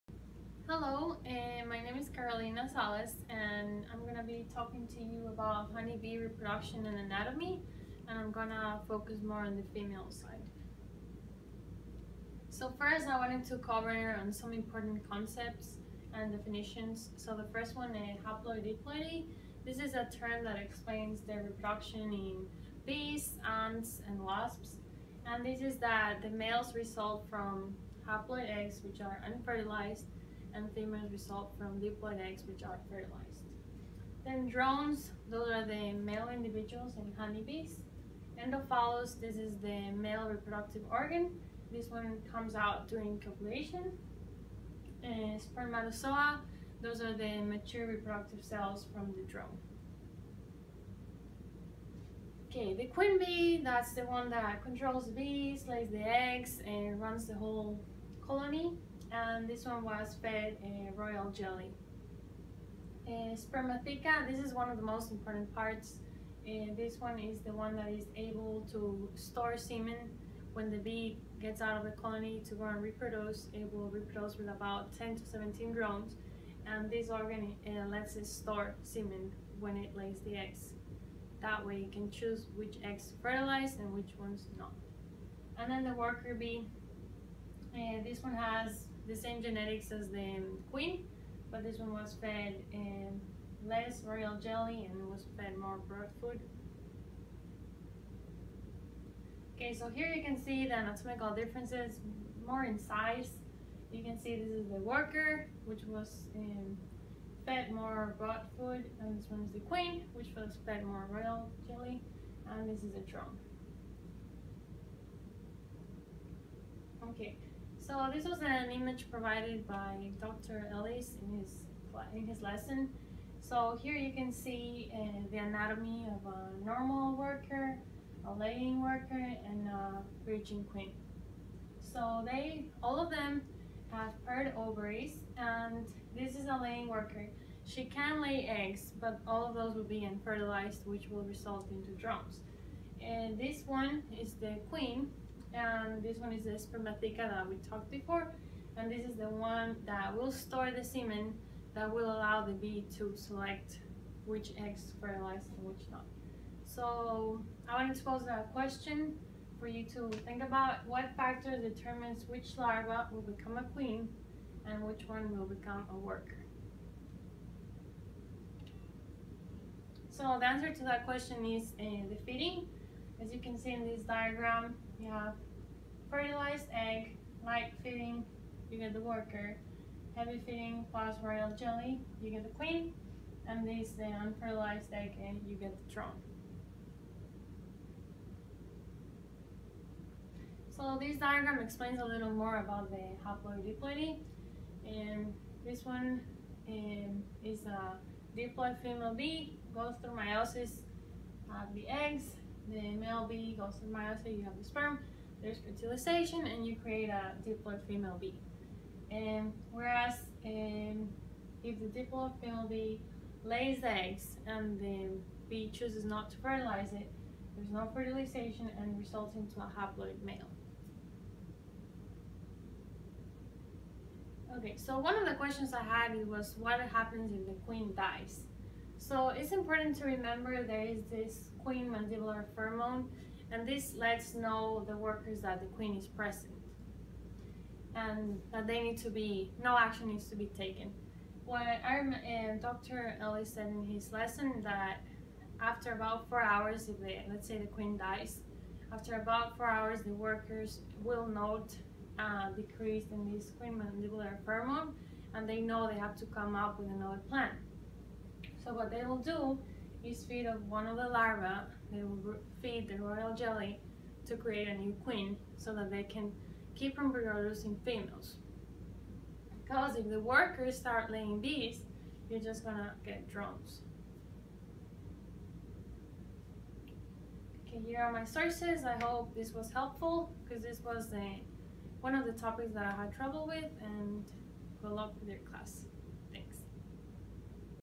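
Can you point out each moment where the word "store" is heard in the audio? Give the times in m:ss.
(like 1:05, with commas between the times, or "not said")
1:09, 1:18, 2:30.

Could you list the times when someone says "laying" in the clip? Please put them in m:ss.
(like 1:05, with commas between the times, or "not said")
2:08, 2:16, 4:31.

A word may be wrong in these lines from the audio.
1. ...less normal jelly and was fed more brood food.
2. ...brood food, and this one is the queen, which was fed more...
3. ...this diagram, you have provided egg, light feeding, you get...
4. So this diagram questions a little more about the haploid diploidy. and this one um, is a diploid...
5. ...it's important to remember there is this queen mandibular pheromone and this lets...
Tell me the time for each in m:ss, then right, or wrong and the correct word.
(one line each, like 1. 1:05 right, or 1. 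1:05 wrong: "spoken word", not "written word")
1. 1:33 wrong: "royal", not "normal"
2. 1:48 right
3. 2:53 wrong: "fertilized", not "provided"
4. 3:10 wrong: "explains", not "questions"
5. 3:49 right.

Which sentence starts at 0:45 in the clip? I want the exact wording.
And spermatozoa, those are the mature reproductive cells from the drone.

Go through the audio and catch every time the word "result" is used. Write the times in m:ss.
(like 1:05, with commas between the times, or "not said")
0:26, 0:31, 2:21, 3:38.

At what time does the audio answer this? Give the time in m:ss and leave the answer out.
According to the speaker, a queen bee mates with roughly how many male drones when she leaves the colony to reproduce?
1:14.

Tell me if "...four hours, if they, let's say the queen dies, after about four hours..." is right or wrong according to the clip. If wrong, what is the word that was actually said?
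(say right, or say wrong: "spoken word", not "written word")
right.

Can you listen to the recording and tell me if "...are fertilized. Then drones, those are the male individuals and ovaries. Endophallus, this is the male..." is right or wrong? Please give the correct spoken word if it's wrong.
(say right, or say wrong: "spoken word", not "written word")
wrong: "honeybees", not "ovaries".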